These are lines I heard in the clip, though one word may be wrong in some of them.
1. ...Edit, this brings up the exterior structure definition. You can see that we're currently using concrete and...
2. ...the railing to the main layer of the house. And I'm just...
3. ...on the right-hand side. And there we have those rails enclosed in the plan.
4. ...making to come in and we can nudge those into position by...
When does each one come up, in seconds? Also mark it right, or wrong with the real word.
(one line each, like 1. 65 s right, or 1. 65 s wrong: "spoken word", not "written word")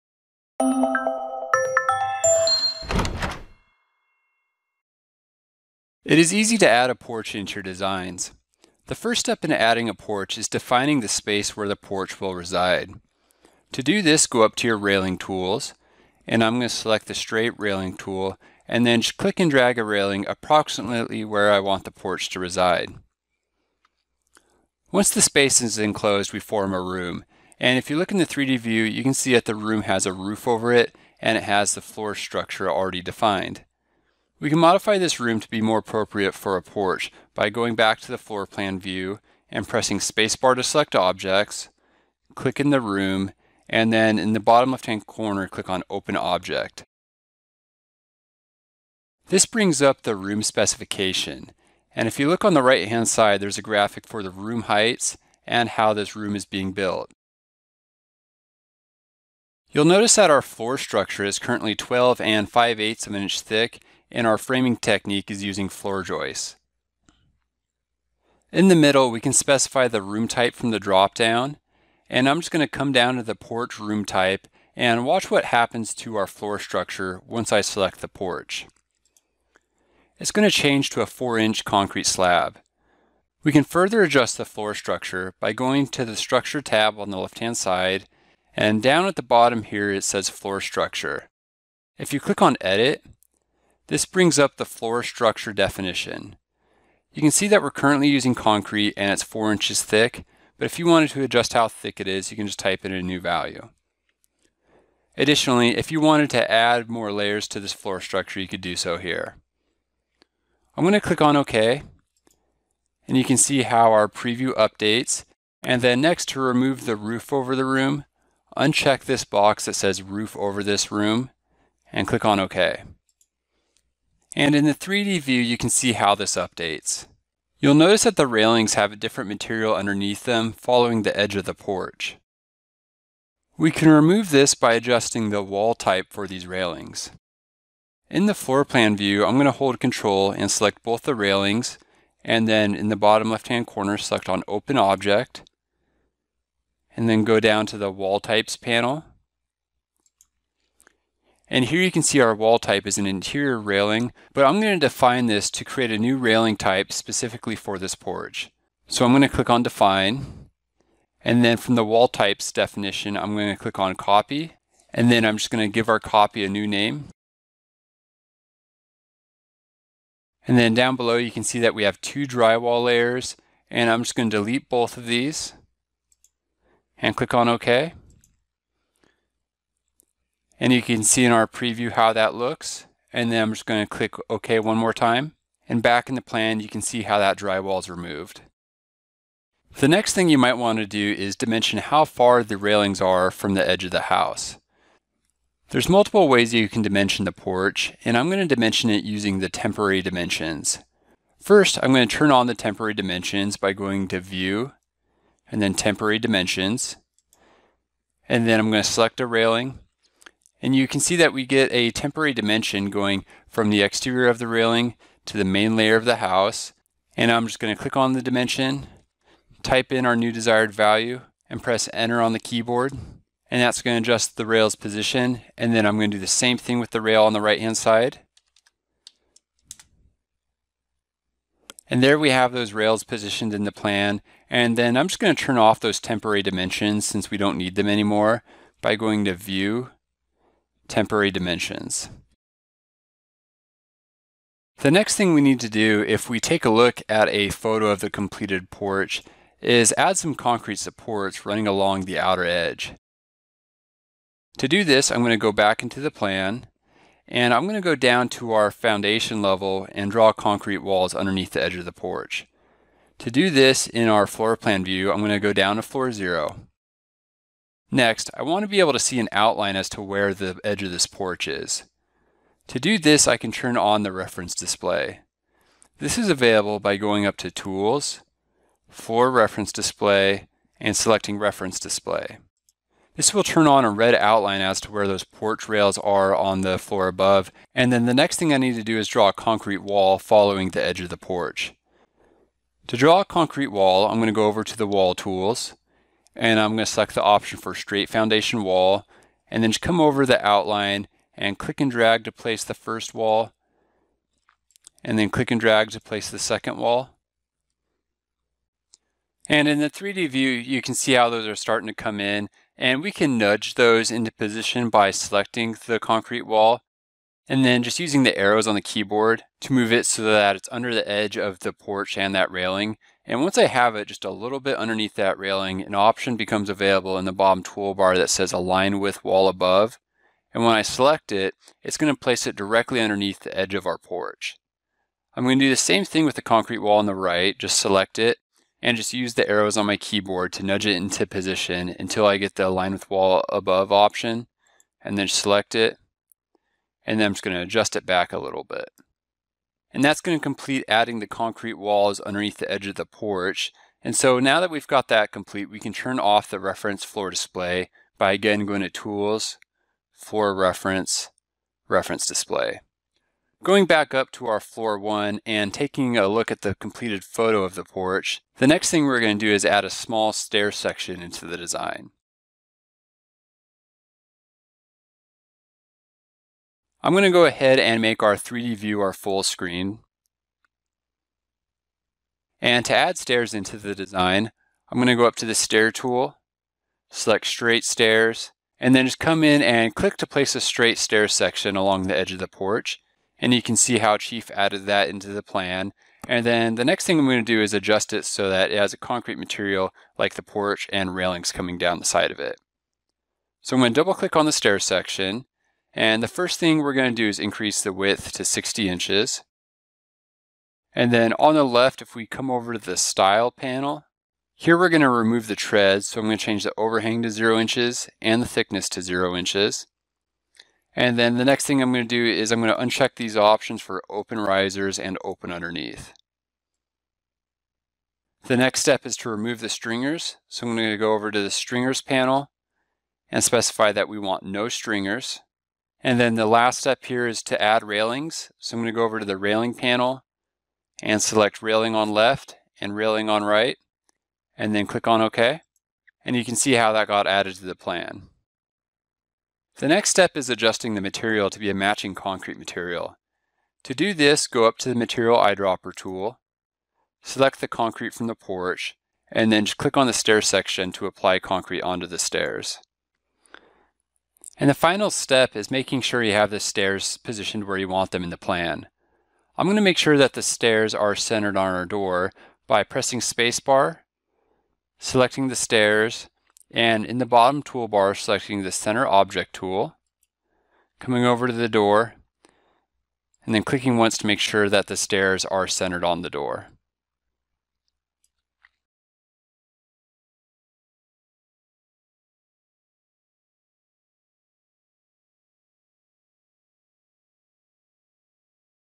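1. 92 s wrong: "floor", not "exterior"
2. 214 s right
3. 227 s wrong: "positioned", not "enclosed"
4. 311 s wrong: "starting", not "making".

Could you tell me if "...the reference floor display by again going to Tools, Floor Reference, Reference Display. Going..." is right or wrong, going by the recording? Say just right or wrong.
right.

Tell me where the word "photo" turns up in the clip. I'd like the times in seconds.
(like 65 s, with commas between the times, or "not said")
247 s, 367 s.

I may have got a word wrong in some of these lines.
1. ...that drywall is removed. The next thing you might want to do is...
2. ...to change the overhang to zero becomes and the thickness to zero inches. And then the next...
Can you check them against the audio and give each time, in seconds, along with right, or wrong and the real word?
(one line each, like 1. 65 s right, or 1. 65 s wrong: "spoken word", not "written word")
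1. 187 s right
2. 416 s wrong: "inches", not "becomes".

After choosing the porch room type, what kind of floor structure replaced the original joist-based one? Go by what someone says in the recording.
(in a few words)
4-inch concrete slab.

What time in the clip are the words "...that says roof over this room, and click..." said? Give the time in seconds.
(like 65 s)
119 s.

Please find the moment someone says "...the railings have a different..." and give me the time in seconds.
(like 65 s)
128 s.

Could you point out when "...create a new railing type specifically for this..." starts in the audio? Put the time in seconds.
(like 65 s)
155 s.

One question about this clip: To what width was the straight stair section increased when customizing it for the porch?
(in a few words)
60 inches.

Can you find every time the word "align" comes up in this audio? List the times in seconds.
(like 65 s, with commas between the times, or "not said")
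328 s, 342 s.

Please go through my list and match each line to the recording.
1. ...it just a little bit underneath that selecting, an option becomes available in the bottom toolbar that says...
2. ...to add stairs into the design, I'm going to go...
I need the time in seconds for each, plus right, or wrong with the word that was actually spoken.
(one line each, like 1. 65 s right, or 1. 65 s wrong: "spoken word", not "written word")
1. 323 s wrong: "railing", not "selecting"
2. 382 s right.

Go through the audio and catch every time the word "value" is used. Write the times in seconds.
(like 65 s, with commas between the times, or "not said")
103 s, 220 s.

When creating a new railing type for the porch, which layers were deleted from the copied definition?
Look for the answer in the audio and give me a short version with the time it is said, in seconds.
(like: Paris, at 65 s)
Two drywall layers, at 171 s.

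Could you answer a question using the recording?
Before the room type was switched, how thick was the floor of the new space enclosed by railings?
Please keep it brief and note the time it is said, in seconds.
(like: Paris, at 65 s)
12 5/8 inches, at 61 s.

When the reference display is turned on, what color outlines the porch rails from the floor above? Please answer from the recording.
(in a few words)
Red.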